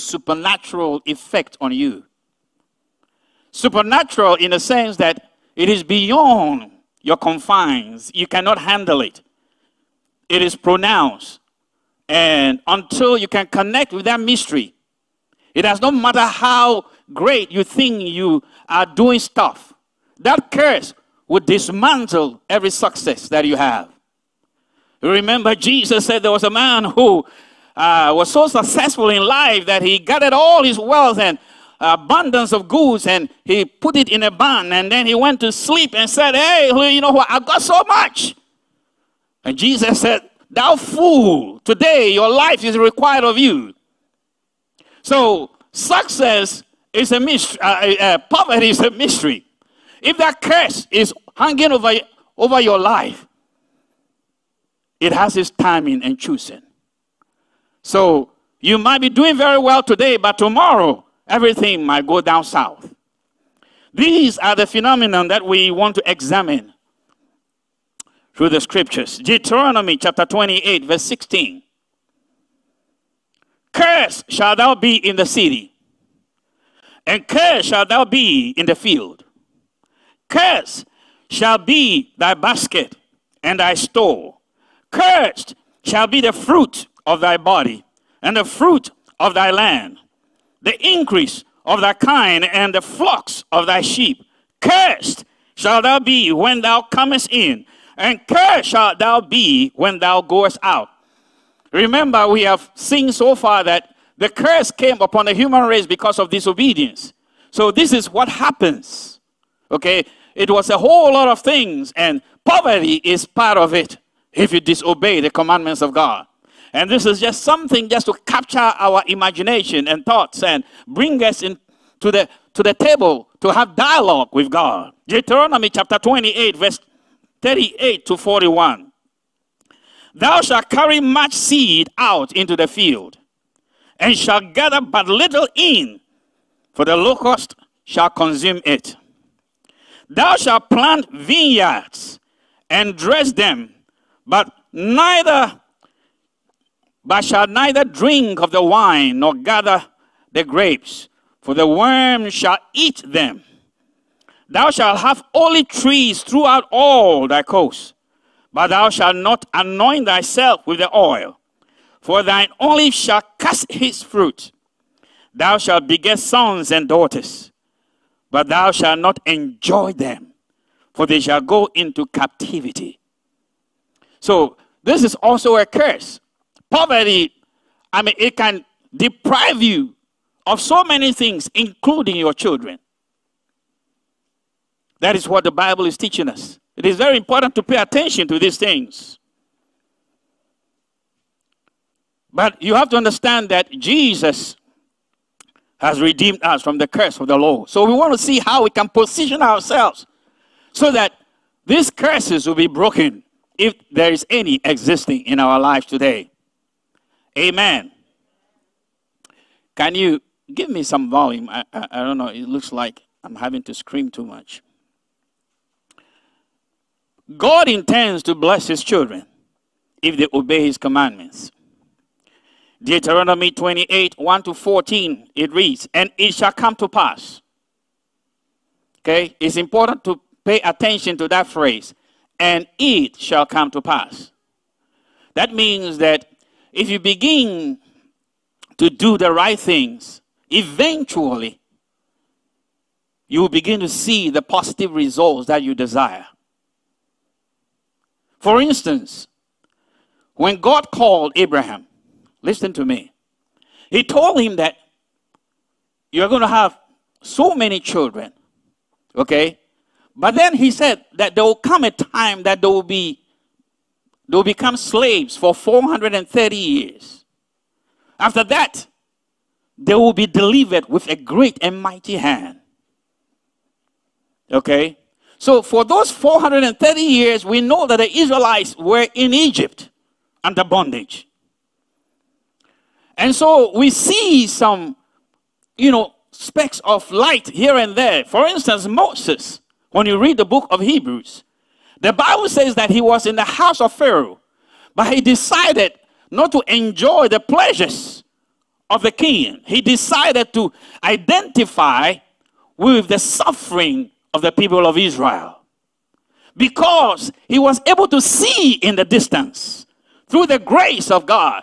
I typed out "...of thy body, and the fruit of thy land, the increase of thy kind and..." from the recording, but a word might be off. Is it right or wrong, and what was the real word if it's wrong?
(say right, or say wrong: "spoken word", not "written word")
right.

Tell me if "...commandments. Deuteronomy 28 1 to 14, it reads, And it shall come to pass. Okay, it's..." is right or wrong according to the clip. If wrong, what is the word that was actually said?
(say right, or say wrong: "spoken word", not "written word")
right.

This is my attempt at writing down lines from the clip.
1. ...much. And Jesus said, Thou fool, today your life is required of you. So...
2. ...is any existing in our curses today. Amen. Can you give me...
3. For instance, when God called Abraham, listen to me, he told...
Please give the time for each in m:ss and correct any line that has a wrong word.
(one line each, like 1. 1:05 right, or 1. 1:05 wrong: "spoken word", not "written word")
1. 0:37 right
2. 3:24 wrong: "lives", not "curses"
3. 4:08 right.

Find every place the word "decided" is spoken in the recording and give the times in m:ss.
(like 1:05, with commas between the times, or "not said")
4:55, 4:59.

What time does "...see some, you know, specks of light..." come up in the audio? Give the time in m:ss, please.
4:43.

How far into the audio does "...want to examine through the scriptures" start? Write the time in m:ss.
1:05.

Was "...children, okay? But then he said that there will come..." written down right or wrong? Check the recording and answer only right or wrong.
right.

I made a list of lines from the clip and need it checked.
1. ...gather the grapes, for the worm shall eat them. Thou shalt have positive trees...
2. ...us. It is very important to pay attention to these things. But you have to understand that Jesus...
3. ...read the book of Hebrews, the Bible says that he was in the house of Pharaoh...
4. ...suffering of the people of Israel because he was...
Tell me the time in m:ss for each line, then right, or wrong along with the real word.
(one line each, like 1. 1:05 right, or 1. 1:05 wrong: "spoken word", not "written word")
1. 2:29 wrong: "olive", not "positive"
2. 3:06 right
3. 4:50 right
4. 5:03 right.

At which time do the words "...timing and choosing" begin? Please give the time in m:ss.
0:55.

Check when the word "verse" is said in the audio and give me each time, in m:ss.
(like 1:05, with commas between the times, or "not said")
1:10, 2:06.